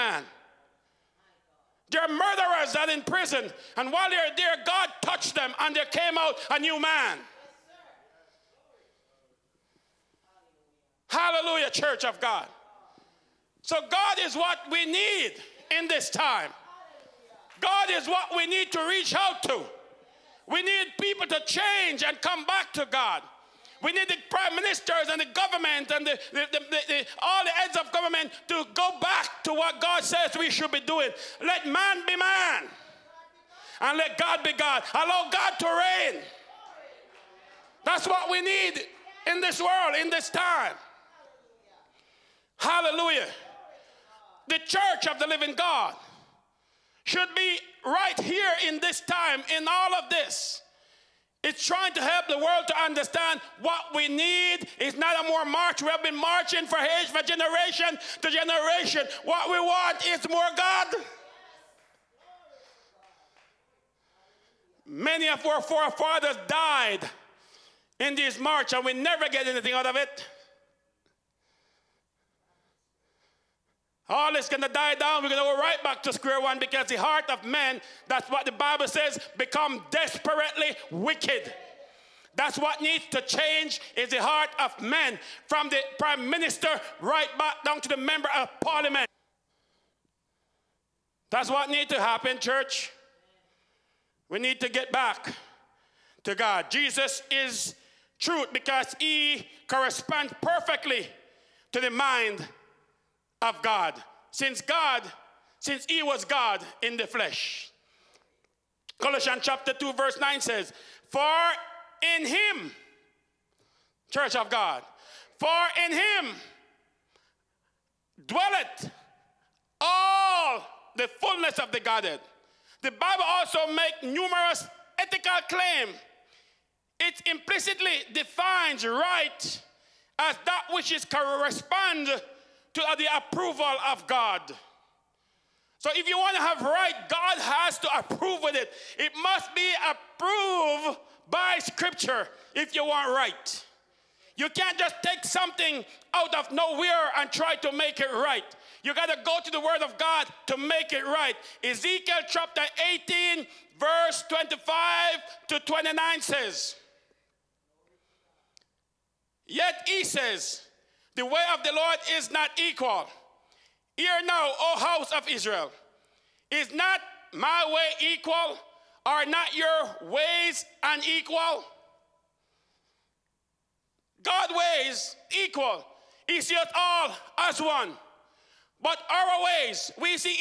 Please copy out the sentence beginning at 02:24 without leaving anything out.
You can't just take something out of nowhere and try to make it right.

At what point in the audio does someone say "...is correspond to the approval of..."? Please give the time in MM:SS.
02:10.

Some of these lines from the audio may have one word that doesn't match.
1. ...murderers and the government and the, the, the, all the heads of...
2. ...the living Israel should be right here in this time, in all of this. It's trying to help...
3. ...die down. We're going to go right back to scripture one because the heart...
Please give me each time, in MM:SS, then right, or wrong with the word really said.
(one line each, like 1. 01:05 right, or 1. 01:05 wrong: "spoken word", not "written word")
1. 00:24 wrong: "ministers", not "murderers"
2. 00:45 wrong: "God", not "Israel"
3. 01:14 wrong: "square", not "scripture".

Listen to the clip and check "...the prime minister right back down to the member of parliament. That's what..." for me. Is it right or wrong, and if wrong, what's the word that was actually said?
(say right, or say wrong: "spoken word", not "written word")
right.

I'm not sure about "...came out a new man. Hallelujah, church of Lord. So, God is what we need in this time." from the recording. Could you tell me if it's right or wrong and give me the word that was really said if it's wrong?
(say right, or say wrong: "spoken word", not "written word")
wrong: "God", not "Lord".